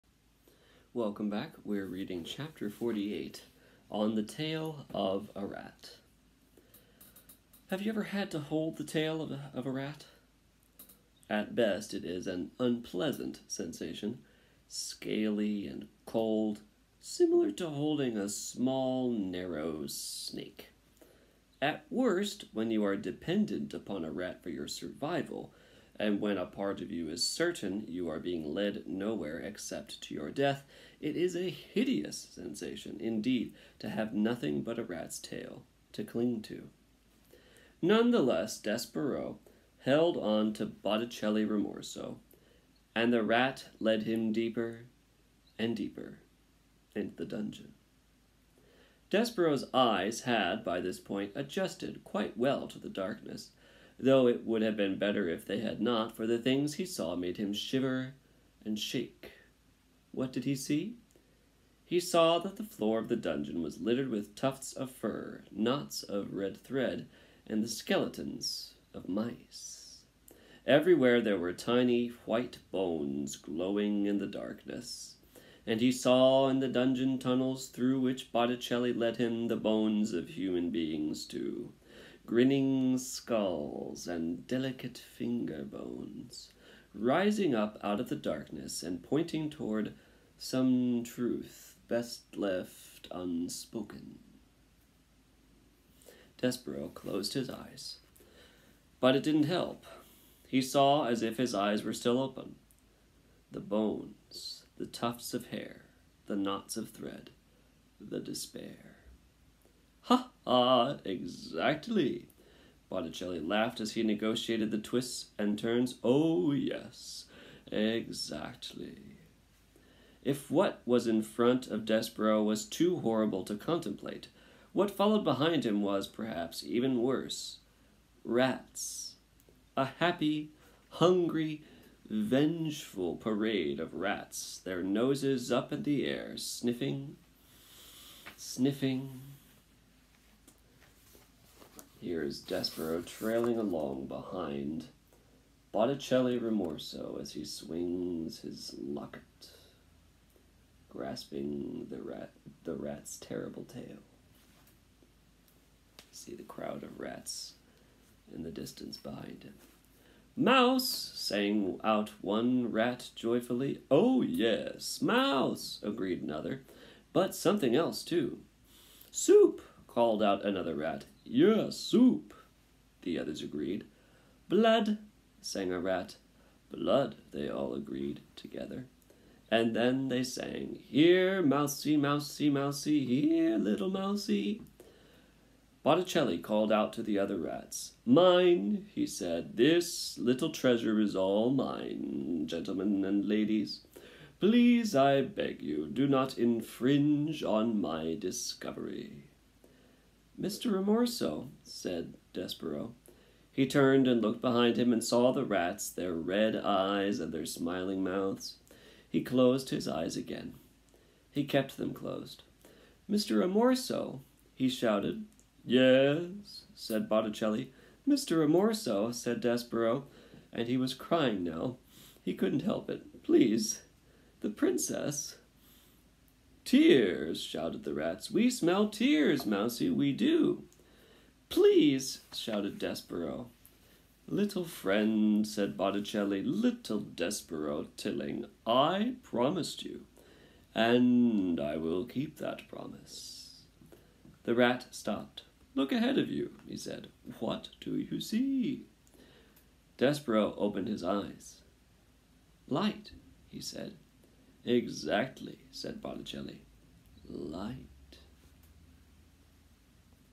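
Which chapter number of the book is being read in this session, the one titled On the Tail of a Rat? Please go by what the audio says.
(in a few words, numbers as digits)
48.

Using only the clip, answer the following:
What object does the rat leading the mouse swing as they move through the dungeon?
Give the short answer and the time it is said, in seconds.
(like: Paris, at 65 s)
His locket, at 148 s.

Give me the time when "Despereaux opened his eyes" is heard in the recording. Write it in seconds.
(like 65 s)
249 s.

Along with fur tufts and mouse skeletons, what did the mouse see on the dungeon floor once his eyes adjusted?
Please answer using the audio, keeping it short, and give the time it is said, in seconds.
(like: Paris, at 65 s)
Knots of red thread, at 65 s.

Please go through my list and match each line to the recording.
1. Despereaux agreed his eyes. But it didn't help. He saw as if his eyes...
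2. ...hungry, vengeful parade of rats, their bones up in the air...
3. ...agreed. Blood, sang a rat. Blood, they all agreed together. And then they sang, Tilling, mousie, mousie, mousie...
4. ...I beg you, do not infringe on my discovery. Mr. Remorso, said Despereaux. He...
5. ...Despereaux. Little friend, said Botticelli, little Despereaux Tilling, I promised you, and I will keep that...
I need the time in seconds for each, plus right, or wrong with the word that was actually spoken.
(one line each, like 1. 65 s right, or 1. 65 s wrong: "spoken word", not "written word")
1. 96 s wrong: "closed", not "agreed"
2. 130 s wrong: "noses", not "bones"
3. 173 s wrong: "Here", not "Tilling"
4. 194 s right
5. 232 s right.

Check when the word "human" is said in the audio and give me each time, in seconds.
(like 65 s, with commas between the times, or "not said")
80 s.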